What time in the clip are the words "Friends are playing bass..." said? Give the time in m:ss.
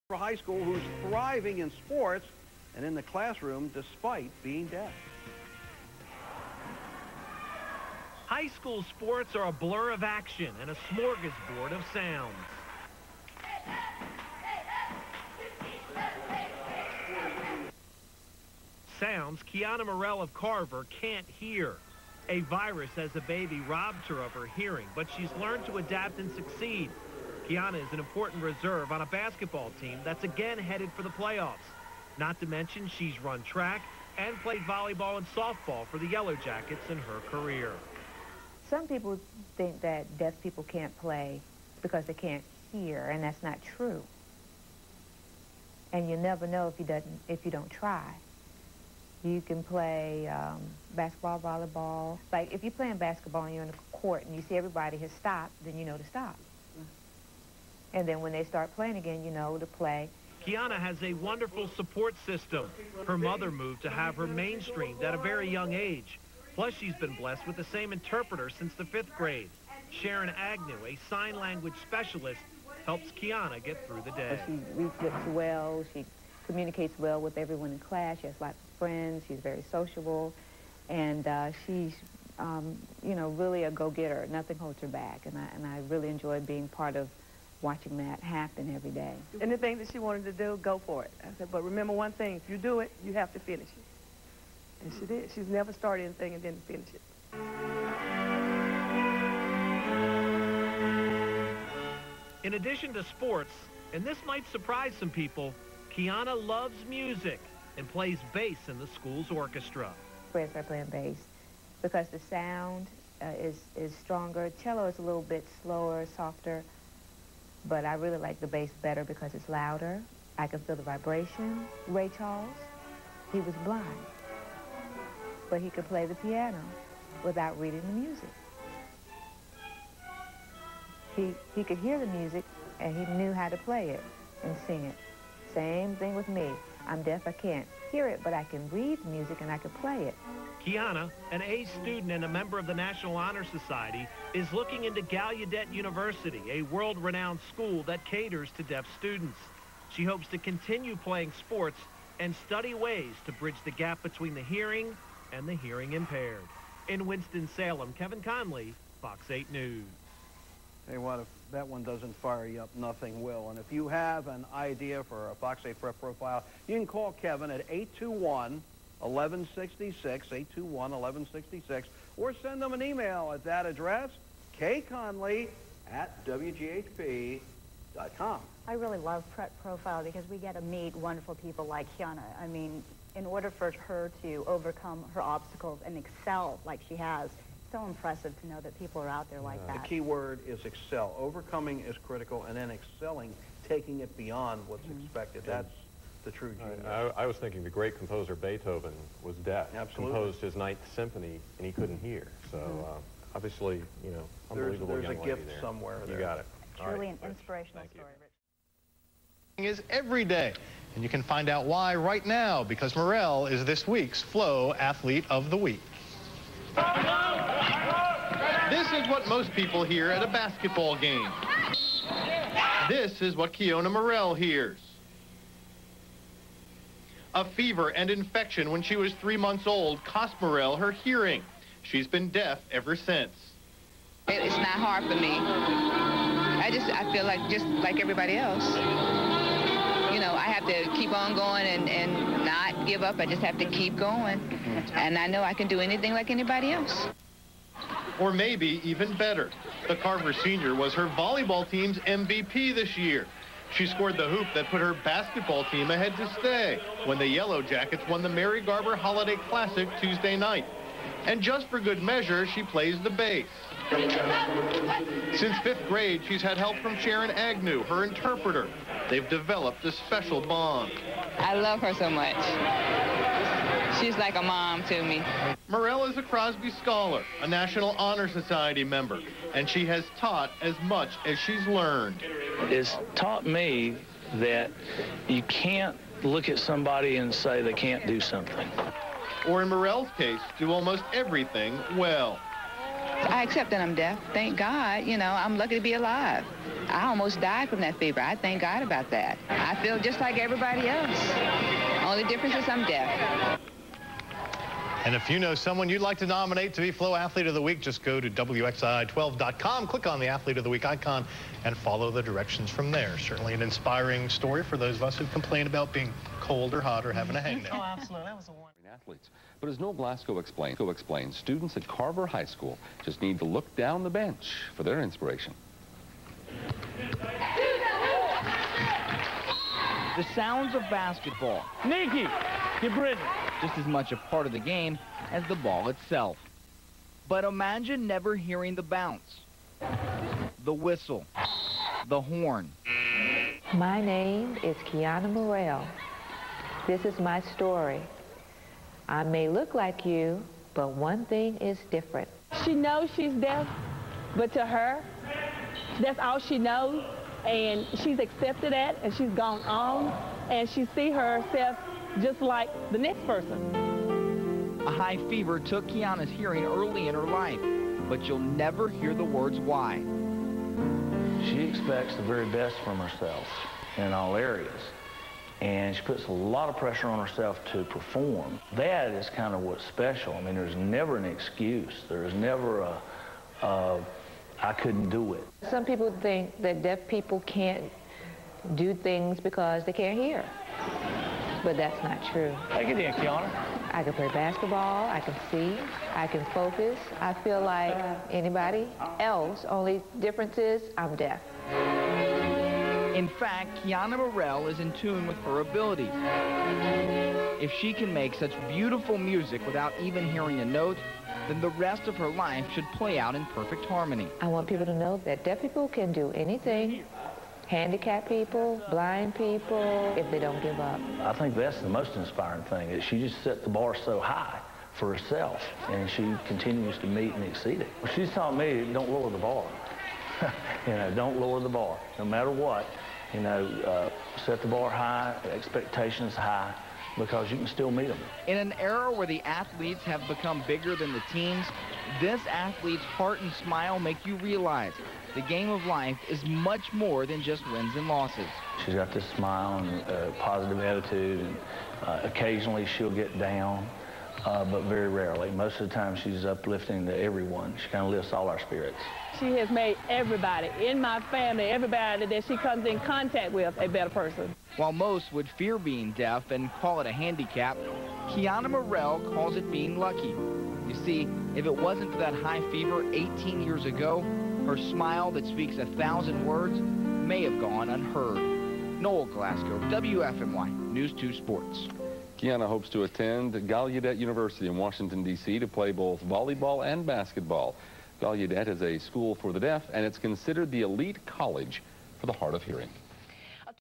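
1:50.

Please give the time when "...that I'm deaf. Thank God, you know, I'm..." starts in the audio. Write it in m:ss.
4:53.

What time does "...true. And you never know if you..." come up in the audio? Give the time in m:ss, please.
0:43.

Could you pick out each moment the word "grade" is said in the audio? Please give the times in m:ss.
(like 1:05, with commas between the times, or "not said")
1:09, 4:25.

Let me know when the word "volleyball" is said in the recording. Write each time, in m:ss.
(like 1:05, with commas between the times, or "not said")
0:34, 0:51, 4:11, 8:06.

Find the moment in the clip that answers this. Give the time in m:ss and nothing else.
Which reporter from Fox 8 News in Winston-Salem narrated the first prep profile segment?
2:37.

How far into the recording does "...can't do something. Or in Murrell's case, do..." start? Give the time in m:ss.
4:47.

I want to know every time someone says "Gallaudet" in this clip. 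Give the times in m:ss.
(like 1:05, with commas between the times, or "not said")
2:25, 8:03, 8:08.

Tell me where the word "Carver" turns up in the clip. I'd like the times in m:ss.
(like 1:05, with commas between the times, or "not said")
0:20, 4:09, 5:21.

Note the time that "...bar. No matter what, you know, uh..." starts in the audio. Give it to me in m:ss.
7:11.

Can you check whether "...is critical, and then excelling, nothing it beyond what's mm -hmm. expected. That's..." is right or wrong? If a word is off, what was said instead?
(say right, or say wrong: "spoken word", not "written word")
wrong: "taking", not "nothing".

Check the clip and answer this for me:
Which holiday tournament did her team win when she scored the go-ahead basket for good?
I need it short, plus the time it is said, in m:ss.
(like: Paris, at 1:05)
Mary Garber Holiday Classic, at 4:18.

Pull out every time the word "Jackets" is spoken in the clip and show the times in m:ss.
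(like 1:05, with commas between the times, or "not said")
0:36, 4:17.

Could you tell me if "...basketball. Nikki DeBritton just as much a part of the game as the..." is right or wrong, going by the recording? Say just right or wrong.
right.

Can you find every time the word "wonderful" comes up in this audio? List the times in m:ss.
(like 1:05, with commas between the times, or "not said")
1:01, 3:00, 5:18.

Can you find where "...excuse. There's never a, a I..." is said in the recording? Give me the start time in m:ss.
6:21.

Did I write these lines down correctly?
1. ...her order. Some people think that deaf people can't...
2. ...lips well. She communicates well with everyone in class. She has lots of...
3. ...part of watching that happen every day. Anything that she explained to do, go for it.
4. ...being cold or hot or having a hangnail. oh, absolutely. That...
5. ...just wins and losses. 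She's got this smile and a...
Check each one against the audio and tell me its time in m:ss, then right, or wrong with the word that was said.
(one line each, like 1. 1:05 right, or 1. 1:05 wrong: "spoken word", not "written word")
1. 0:36 wrong: "career", not "order"
2. 1:15 right
3. 1:26 wrong: "wanted", not "explained"
4. 5:15 right
5. 7:27 right.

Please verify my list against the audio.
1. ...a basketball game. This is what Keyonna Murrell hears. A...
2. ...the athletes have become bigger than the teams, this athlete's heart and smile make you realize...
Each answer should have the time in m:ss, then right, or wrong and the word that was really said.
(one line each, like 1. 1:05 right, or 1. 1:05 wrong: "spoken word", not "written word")
1. 3:40 right
2. 7:19 right.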